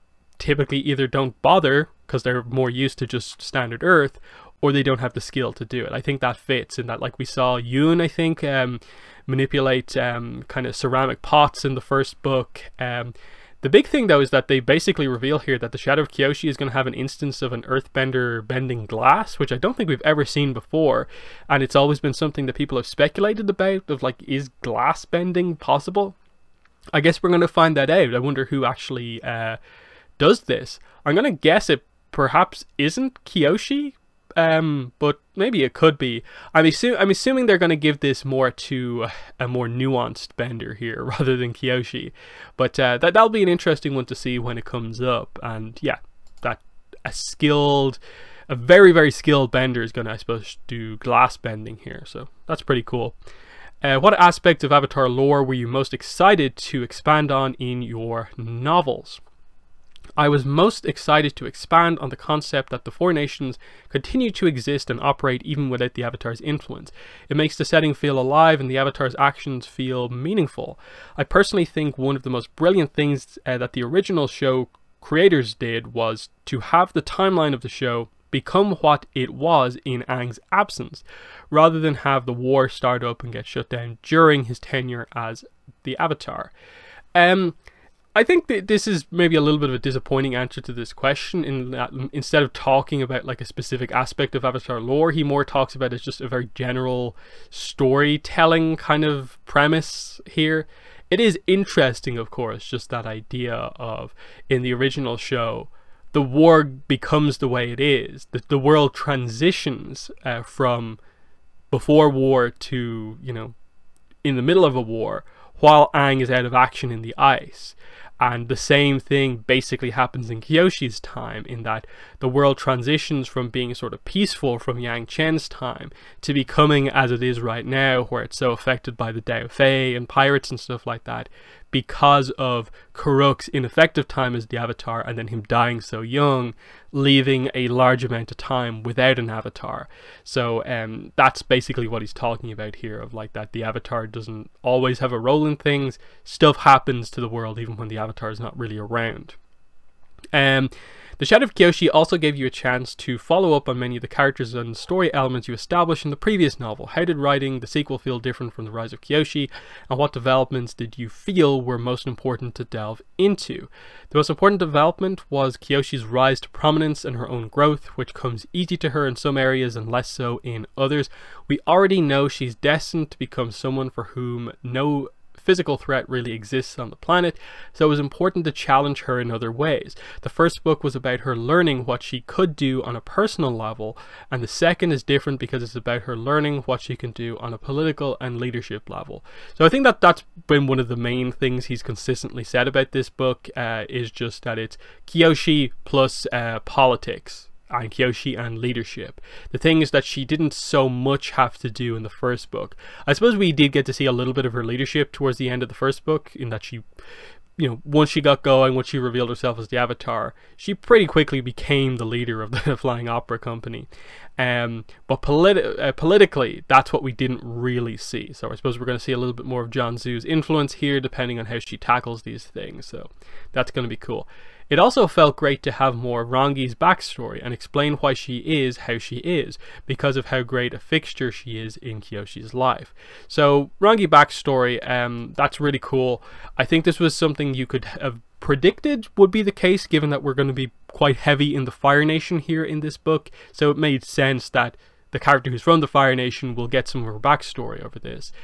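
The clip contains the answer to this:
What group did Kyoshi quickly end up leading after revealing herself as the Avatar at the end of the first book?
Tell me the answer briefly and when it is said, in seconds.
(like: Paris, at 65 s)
Flying Opera Company, at 212 s.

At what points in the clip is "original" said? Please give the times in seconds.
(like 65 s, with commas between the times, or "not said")
73 s, 104 s.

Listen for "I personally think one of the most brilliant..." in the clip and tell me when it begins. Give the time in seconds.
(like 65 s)
71 s.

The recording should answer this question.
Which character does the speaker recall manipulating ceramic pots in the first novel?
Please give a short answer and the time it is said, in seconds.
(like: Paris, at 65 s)
Yun, at 7 s.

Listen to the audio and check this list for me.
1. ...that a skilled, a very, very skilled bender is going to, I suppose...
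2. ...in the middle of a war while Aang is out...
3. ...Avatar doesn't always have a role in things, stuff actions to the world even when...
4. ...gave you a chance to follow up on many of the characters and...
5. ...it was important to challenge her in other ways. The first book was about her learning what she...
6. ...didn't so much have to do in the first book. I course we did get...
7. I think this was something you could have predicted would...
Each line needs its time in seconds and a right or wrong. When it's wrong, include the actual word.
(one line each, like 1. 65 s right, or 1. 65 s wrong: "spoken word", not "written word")
1. 46 s right
2. 114 s right
3. 143 s wrong: "happens", not "actions"
4. 152 s right
5. 177 s right
6. 200 s wrong: "suppose", not "course"
7. 236 s right.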